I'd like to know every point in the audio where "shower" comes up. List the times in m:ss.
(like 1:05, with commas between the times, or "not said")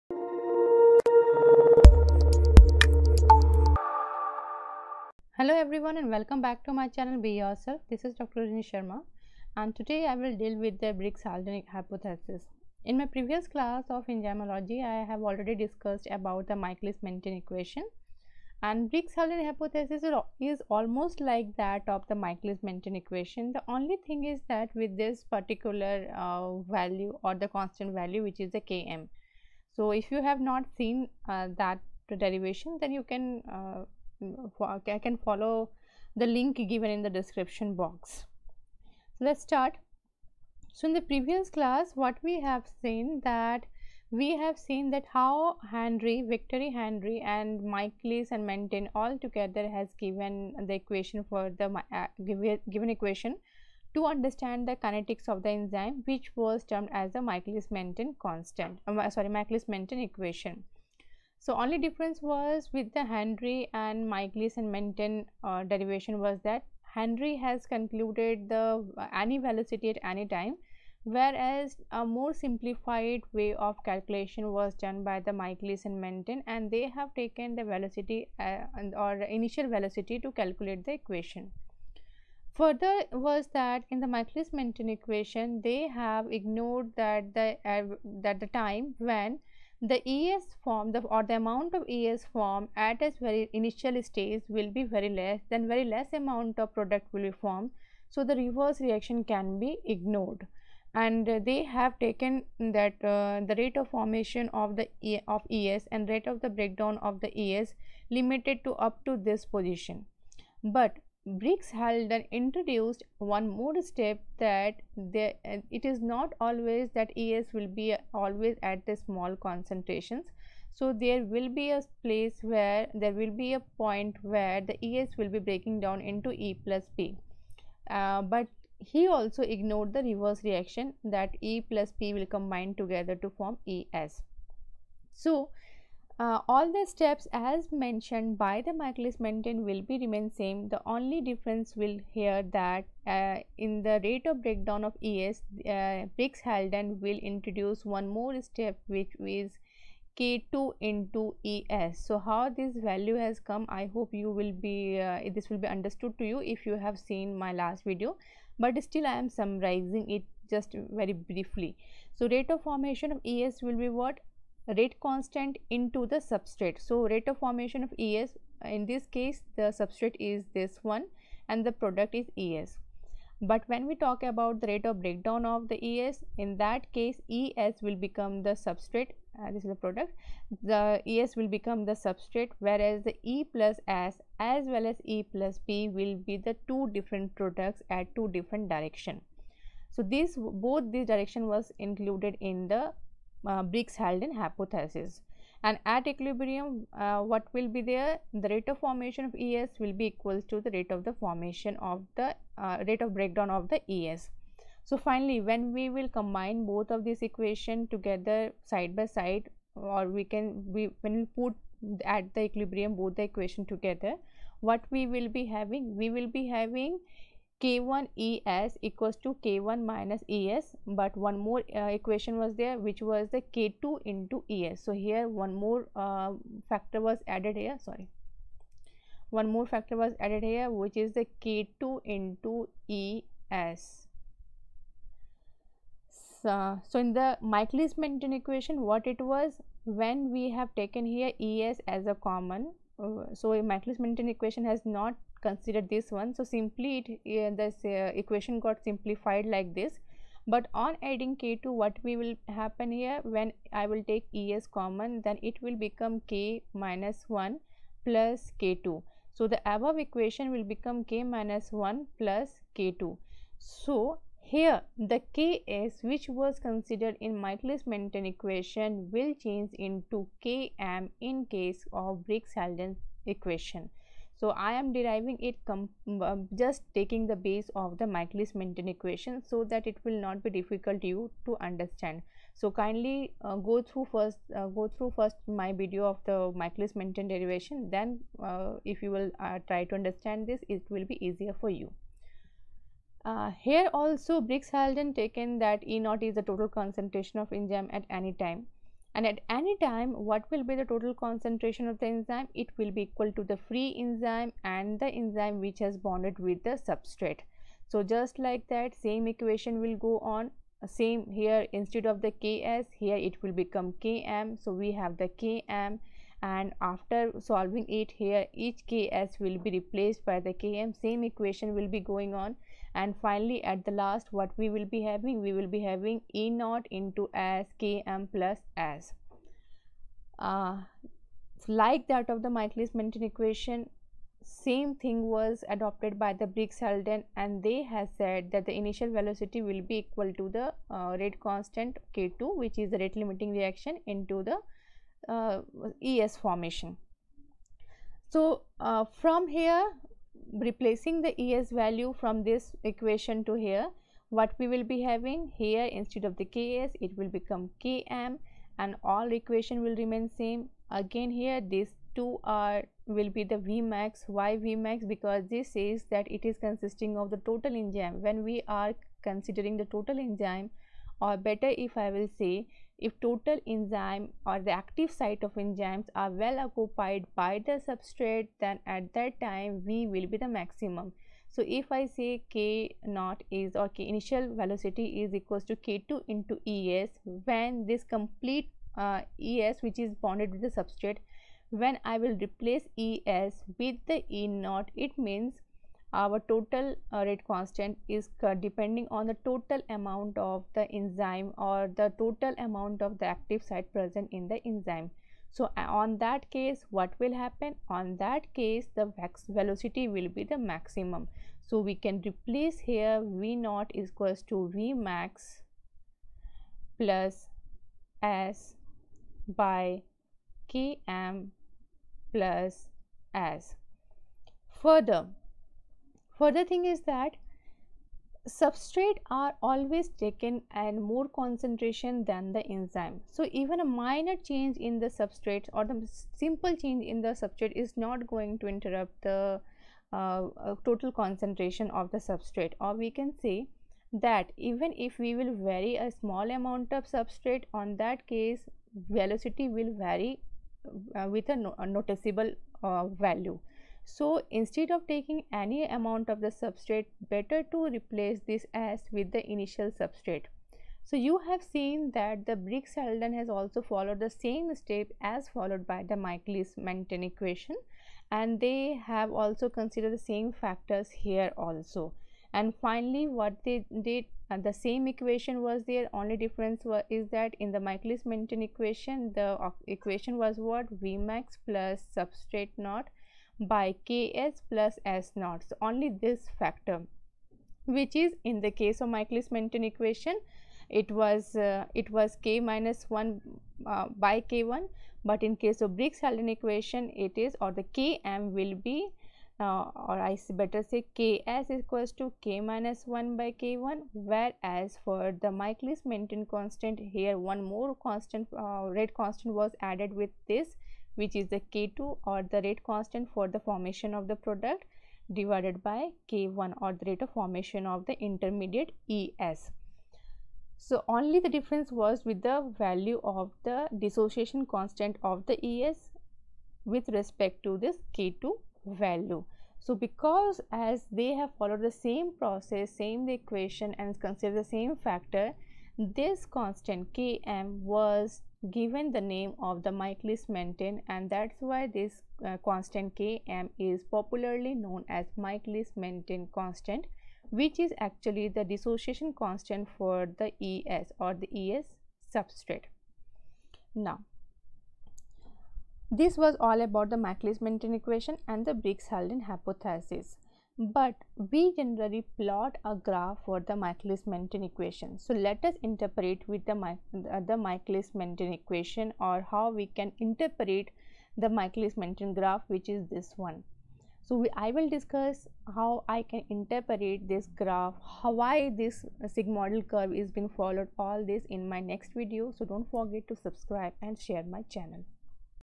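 not said.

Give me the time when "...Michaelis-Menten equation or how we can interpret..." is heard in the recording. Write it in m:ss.
9:27.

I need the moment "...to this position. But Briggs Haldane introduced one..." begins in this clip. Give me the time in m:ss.
1:49.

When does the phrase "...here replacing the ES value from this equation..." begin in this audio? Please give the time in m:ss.
5:49.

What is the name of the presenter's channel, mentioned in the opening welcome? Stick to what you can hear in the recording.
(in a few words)
Be Yourself.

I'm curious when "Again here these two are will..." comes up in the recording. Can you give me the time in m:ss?
6:00.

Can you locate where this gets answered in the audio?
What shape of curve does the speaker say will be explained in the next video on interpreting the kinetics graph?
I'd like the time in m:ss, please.
9:39.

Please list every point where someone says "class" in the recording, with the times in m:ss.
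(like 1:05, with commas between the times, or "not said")
0:13, 0:41.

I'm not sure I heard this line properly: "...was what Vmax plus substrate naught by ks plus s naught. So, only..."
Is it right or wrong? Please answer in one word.
right.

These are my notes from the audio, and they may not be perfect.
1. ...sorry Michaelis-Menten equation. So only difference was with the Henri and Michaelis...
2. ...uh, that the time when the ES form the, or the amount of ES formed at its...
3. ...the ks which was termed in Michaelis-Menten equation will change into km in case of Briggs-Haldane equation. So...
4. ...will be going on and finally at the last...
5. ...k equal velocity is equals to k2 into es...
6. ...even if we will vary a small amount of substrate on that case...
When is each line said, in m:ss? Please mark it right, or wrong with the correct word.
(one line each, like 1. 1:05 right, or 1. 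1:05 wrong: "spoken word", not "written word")
1. 0:59 right
2. 1:27 right
3. 4:24 wrong: "considered", not "termed"
4. 5:21 right
5. 6:23 wrong: "initial", not "equal"
6. 7:24 right.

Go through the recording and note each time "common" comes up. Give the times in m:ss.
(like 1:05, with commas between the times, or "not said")
4:02, 4:14.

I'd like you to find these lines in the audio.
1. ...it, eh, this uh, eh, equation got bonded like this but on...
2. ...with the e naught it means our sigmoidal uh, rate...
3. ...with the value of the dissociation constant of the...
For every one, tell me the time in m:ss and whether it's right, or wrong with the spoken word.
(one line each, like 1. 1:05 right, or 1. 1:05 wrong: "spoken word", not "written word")
1. 4:06 wrong: "simplified", not "bonded"
2. 6:33 wrong: "total", not "sigmoidal"
3. 8:42 right.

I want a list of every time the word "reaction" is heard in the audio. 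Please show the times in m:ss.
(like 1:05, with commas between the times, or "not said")
1:38, 2:10, 5:43.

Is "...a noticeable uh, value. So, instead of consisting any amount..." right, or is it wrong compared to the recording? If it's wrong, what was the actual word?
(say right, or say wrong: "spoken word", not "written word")
wrong: "taking", not "consisting".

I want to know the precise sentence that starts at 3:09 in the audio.
So, this both this direction was included in the uh, Briggs-Haldane hypothesis.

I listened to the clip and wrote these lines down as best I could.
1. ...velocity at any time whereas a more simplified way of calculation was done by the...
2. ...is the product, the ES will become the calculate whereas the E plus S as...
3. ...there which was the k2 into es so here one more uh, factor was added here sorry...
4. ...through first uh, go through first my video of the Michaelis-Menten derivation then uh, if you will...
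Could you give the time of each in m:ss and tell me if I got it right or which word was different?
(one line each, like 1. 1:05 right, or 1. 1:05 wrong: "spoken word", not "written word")
1. 1:09 right
2. 2:59 wrong: "substrate", not "calculate"
3. 3:42 right
4. 4:43 right.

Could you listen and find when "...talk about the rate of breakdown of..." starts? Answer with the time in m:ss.
2:53.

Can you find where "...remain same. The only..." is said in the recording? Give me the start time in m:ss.
2:20.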